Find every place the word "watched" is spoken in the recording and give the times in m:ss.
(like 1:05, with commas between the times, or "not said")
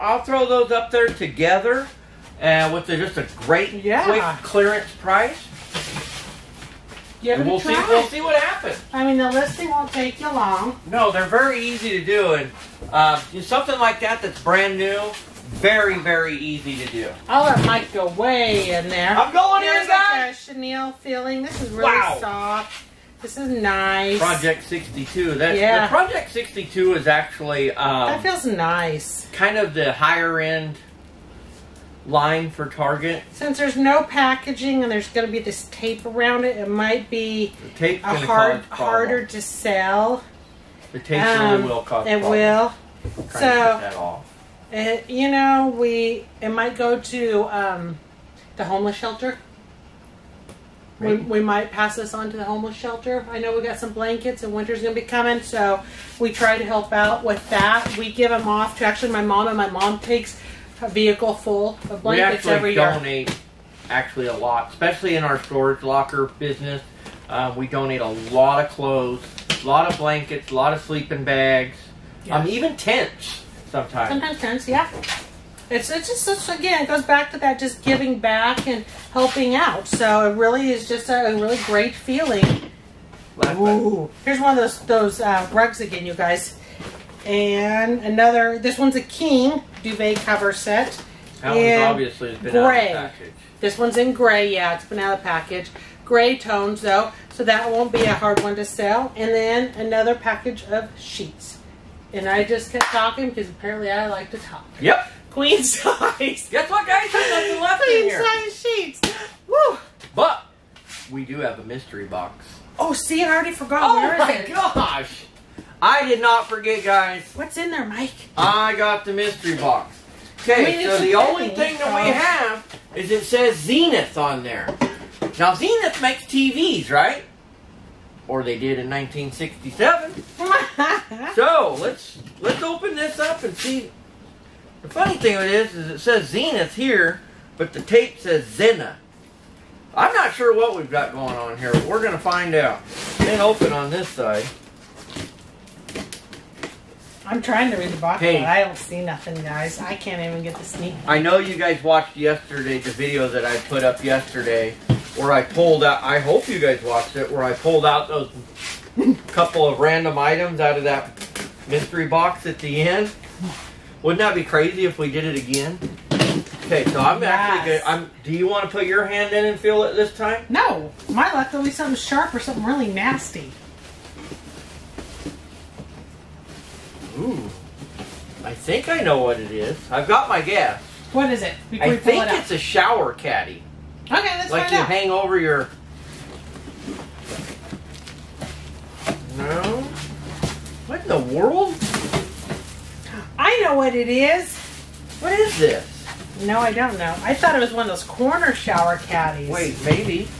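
2:31, 2:36.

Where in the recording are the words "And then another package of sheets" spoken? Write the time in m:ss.
1:39.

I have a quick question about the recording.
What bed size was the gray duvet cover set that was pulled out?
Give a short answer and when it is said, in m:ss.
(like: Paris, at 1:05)
king, at 1:29.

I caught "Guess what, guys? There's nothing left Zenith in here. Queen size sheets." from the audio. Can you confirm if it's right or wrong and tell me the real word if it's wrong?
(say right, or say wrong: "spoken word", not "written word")
wrong: "Queen", not "Zenith".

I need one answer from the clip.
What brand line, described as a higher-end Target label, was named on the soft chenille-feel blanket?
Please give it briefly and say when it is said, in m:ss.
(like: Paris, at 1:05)
Project 62, at 0:25.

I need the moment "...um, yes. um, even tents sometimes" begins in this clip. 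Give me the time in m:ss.
1:12.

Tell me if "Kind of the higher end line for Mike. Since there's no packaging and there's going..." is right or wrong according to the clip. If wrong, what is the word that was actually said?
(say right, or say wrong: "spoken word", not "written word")
wrong: "Target", not "Mike".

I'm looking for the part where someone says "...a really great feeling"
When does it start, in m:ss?
1:21.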